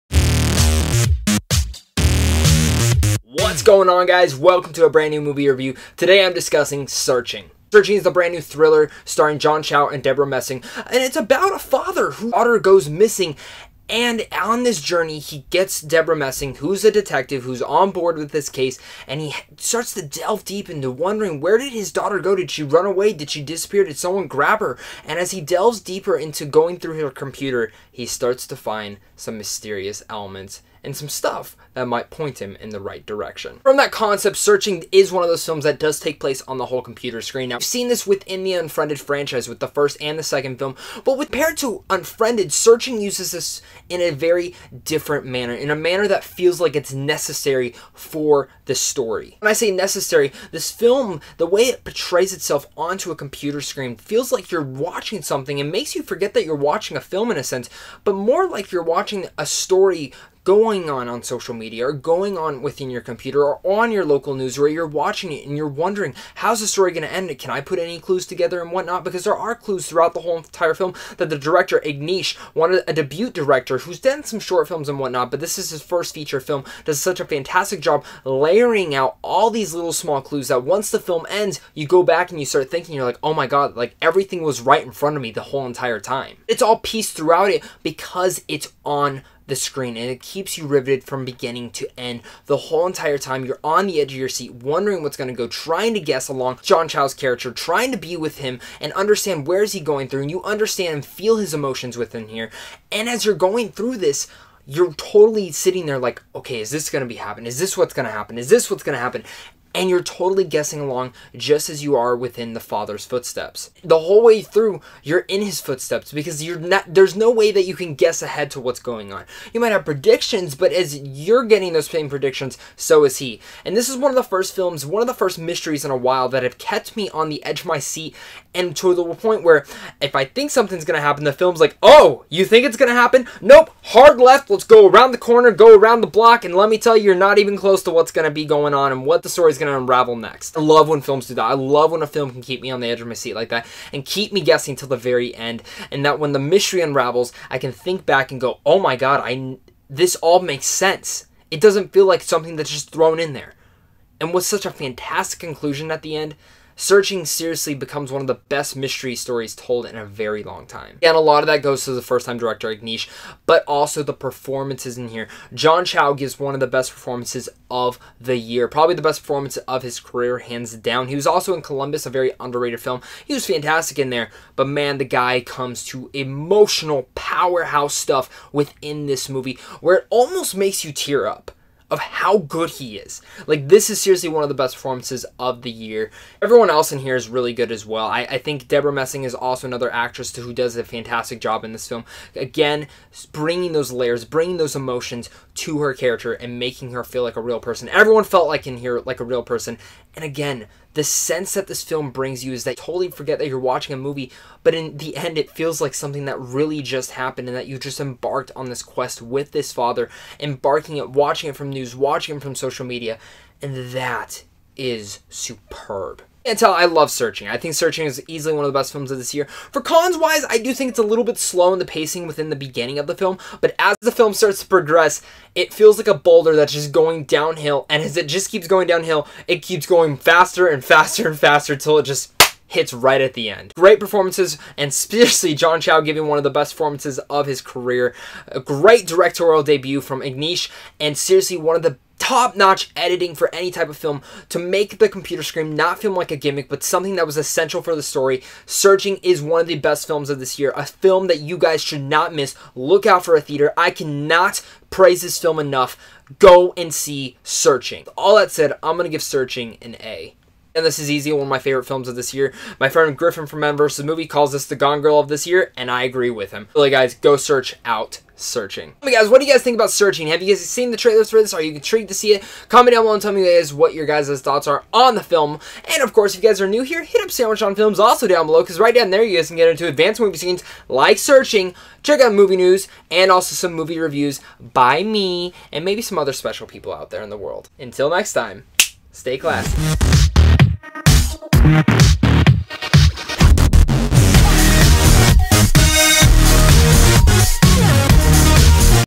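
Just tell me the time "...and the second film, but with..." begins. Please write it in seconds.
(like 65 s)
40 s.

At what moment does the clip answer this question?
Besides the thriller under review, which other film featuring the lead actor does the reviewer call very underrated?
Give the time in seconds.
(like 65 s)
171 s.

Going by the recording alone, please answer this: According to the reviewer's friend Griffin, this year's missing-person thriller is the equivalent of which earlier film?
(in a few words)
Gone Girl.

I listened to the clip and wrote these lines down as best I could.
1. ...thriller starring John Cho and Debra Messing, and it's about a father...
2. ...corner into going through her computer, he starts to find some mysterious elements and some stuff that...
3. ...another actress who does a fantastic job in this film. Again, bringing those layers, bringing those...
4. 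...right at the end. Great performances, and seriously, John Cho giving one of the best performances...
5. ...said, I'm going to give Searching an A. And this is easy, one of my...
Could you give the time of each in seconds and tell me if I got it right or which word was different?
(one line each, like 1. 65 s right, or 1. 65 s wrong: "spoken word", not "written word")
1. 8 s right
2. 25 s wrong: "deeper", not "corner"
3. 189 s right
4. 232 s right
5. 258 s right.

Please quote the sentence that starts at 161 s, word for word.
And a lot of that goes to the first time director Aneesh, but also the performances in here.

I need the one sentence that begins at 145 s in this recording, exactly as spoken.
And that when the mystery unravels, I can think back and go, oh my God, I, this all makes sense.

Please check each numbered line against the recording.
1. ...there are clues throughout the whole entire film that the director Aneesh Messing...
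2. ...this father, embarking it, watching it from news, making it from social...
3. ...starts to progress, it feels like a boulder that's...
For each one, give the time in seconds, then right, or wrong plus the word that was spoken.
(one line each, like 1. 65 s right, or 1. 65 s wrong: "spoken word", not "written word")
1. 69 s wrong: "Chaganty", not "Messing"
2. 209 s wrong: "watching", not "making"
3. 224 s right.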